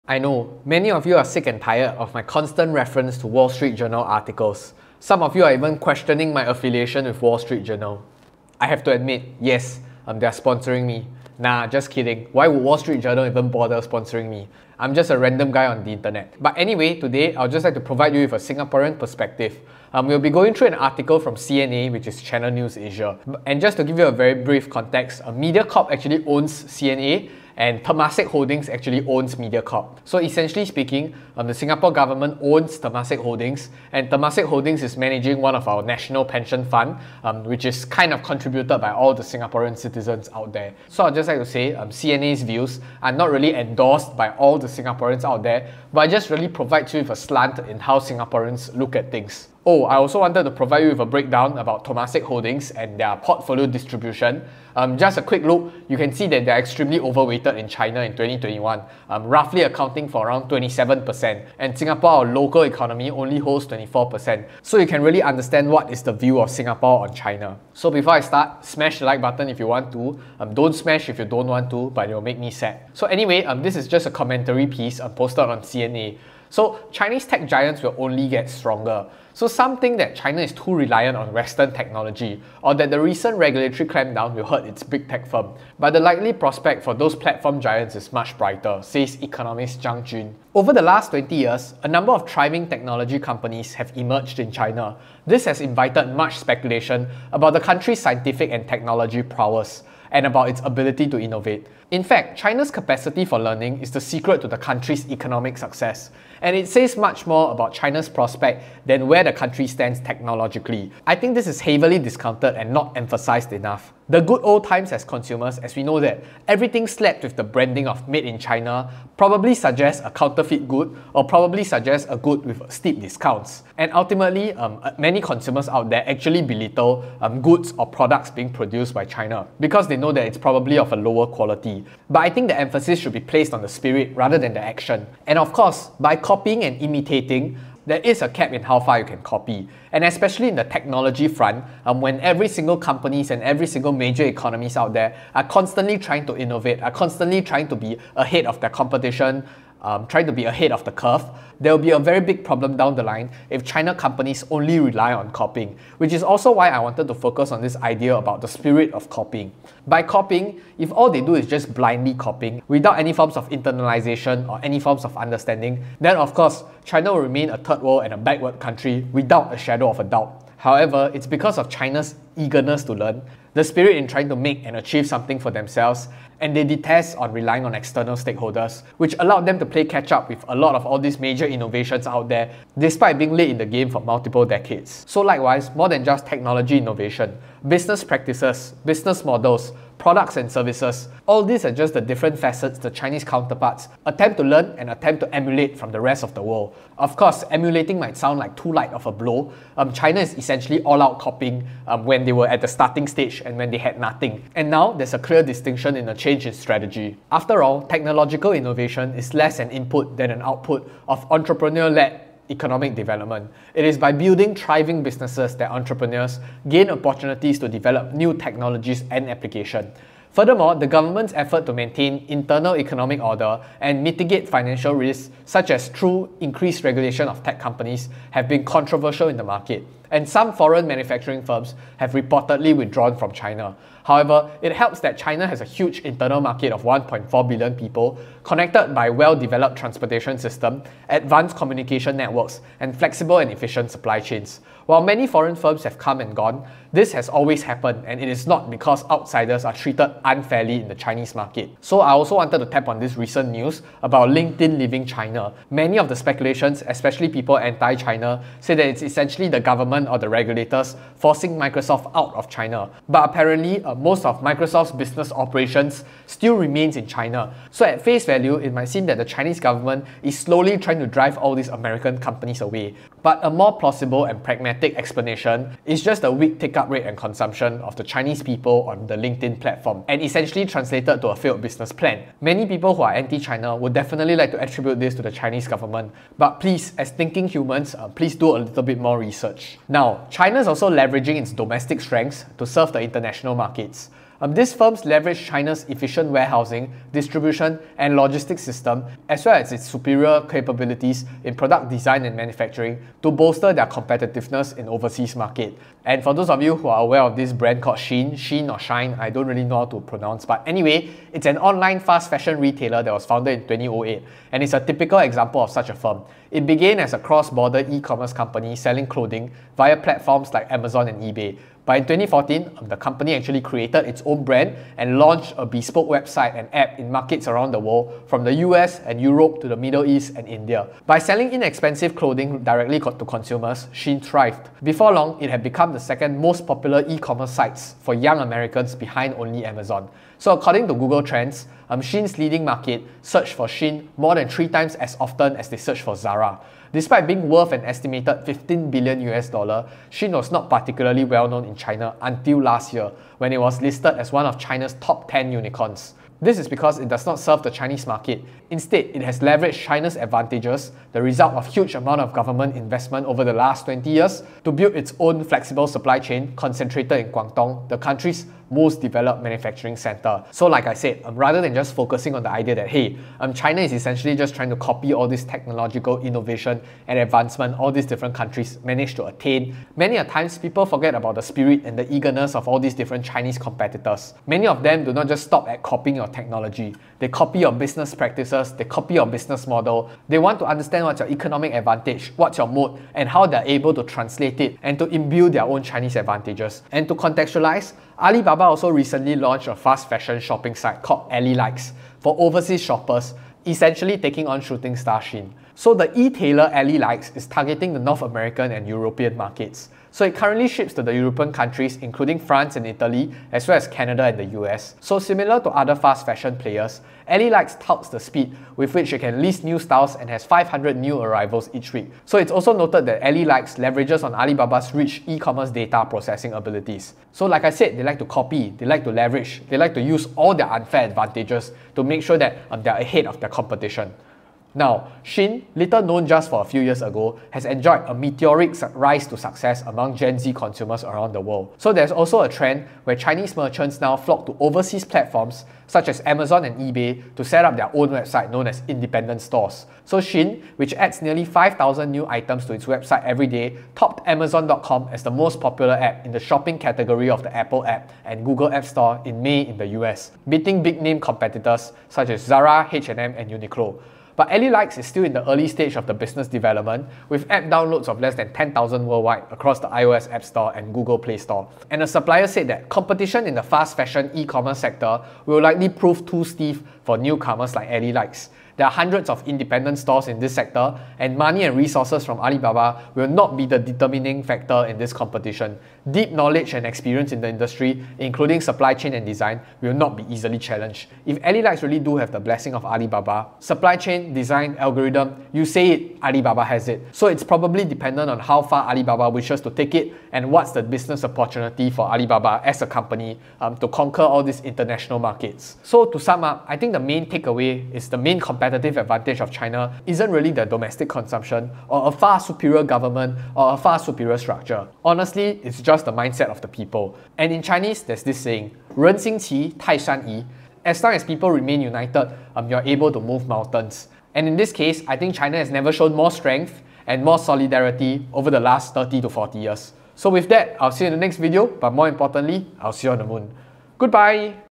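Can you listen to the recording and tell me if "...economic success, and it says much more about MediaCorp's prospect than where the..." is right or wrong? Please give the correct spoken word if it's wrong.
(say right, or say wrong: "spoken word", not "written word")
wrong: "China", not "MediaCorp".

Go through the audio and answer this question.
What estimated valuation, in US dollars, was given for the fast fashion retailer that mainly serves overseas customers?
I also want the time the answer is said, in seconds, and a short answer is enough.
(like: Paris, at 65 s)
15 billion US dollars, at 348 s.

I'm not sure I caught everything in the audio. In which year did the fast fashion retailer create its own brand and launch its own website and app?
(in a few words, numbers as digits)
2014.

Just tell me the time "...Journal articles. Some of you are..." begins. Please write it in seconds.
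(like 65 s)
3 s.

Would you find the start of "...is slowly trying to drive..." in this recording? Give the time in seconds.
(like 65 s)
270 s.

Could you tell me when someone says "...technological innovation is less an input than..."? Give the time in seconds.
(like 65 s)
207 s.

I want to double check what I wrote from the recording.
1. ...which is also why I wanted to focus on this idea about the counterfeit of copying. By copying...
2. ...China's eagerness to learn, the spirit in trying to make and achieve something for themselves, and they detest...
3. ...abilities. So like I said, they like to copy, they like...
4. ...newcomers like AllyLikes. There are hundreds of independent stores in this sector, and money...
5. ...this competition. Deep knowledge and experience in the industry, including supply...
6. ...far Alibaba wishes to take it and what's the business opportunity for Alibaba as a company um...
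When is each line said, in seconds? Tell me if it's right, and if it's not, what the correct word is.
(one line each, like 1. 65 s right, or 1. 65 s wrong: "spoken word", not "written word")
1. 155 s wrong: "spirit", not "counterfeit"
2. 171 s right
3. 426 s right
4. 477 s right
5. 484 s right
6. 498 s right.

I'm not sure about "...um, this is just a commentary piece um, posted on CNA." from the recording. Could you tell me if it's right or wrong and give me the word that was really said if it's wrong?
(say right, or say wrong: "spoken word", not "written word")
right.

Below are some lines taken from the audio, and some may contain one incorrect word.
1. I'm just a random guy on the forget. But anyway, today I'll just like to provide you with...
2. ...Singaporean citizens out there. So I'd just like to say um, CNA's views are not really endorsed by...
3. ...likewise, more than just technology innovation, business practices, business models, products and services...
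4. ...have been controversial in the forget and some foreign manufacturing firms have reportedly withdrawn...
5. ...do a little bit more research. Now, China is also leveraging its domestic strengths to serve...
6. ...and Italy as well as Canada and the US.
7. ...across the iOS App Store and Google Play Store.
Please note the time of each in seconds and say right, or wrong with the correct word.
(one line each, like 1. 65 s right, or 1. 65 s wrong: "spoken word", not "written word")
1. 14 s wrong: "internet", not "forget"
2. 39 s right
3. 185 s right
4. 228 s wrong: "market", not "forget"
5. 288 s right
6. 412 s right
7. 469 s right.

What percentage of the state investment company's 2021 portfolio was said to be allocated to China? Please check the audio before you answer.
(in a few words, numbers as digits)
27%.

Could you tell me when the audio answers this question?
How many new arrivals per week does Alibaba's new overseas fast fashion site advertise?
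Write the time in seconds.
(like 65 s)
420 s.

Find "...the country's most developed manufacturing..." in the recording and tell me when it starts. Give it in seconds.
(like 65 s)
367 s.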